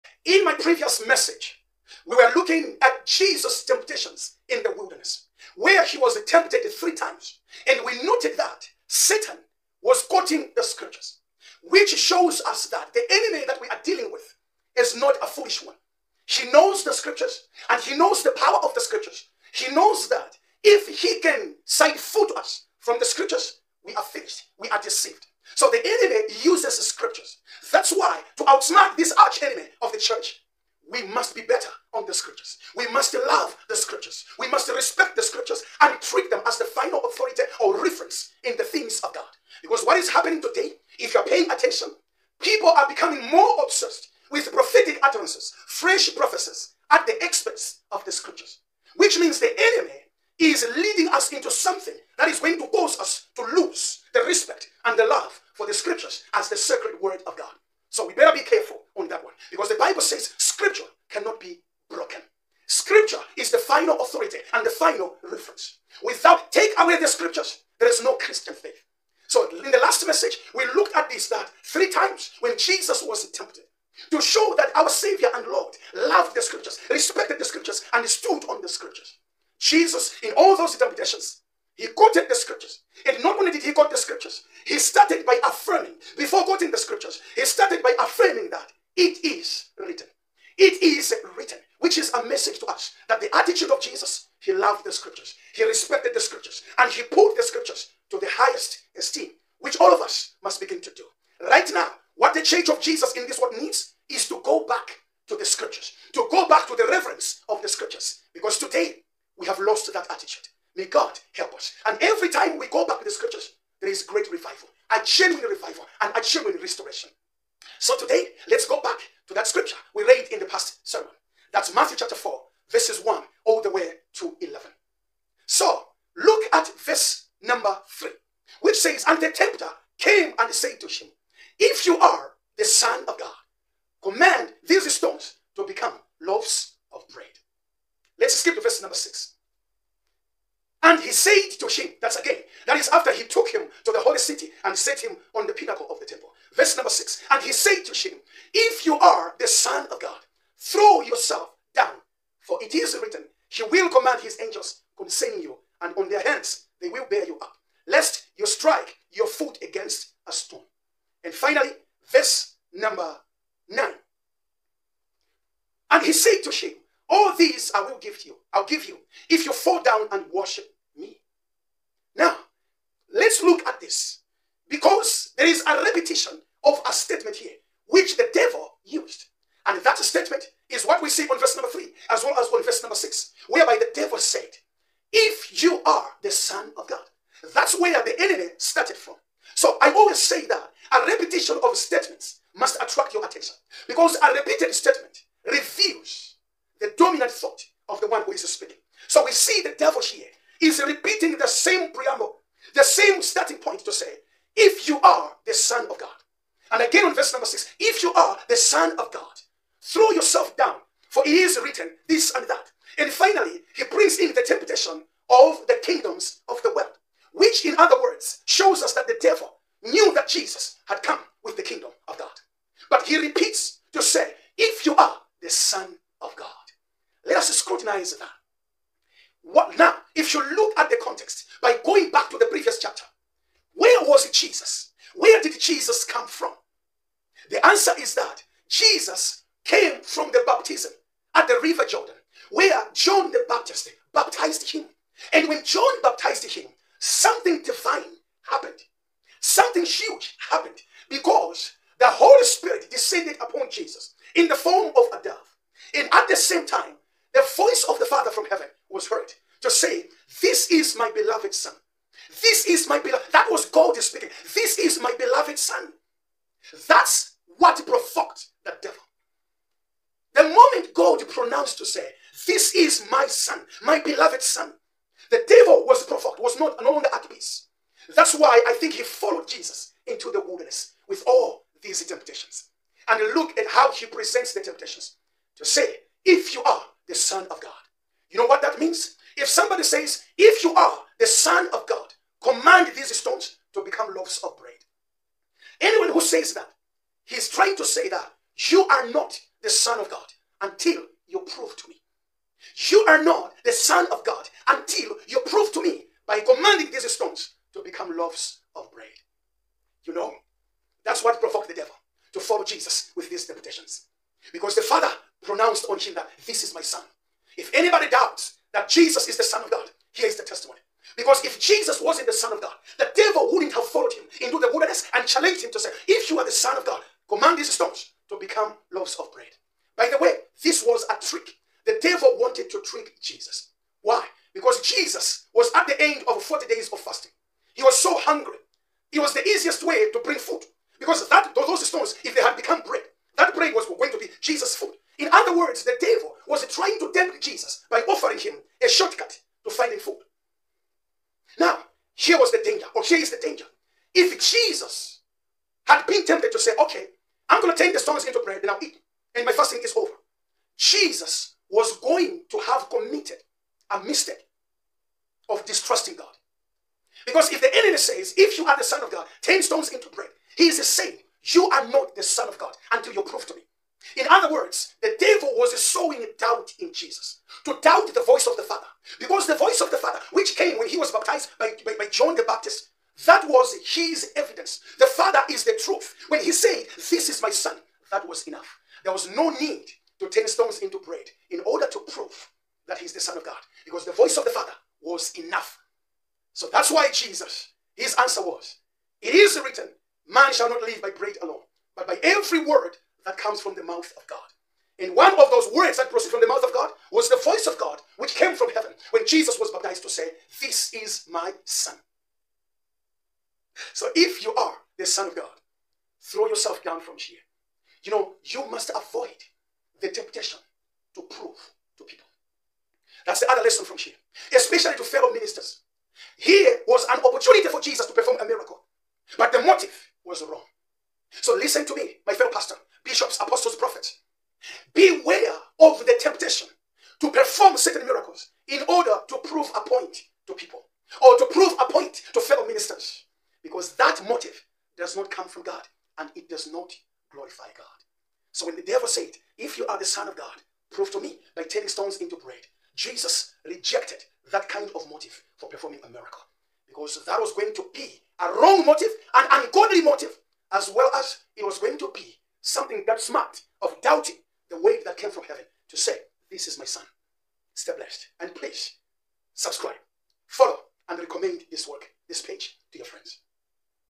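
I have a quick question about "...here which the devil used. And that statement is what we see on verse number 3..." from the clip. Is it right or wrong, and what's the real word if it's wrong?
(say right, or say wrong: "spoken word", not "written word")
right.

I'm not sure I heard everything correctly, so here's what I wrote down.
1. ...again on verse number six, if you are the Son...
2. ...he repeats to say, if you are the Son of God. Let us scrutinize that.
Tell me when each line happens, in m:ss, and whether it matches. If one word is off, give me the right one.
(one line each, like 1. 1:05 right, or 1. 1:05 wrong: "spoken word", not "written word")
1. 3:26 right
2. 3:43 right.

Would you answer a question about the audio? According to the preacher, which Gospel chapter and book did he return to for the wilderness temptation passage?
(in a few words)
Matthew chapter 4.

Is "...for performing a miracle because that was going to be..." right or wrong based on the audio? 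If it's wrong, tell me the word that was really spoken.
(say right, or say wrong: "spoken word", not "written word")
right.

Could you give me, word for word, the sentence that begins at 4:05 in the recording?
And when John baptized him, something divine happened.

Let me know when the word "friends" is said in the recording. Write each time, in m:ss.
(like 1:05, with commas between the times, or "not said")
7:53.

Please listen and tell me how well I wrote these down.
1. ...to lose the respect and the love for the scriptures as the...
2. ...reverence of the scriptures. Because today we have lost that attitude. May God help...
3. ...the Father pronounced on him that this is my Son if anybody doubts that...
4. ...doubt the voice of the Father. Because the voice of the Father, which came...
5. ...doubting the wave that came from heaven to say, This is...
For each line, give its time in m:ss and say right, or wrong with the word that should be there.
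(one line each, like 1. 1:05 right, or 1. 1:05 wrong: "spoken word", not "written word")
1. 0:53 right
2. 1:46 right
3. 5:14 right
4. 6:17 right
5. 7:44 right.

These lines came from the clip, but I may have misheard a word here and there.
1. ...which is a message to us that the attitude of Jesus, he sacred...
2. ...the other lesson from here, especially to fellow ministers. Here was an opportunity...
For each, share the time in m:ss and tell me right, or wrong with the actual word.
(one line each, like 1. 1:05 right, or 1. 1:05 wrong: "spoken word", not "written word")
1. 1:31 wrong: "loved", not "sacred"
2. 7:03 right.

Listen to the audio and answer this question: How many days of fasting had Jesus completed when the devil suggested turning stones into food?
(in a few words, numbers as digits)
40.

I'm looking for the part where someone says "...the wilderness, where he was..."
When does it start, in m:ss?
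0:04.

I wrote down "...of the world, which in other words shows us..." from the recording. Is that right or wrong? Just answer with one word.
right.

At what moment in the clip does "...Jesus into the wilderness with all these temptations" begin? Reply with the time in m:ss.
4:39.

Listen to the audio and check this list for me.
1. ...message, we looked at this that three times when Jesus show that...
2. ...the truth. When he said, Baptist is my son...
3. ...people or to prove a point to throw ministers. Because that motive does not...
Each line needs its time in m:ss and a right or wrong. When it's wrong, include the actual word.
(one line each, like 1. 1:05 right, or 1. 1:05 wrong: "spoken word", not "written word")
1. 1:10 right
2. 6:25 wrong: "This", not "Baptist"
3. 7:20 wrong: "fellow", not "throw".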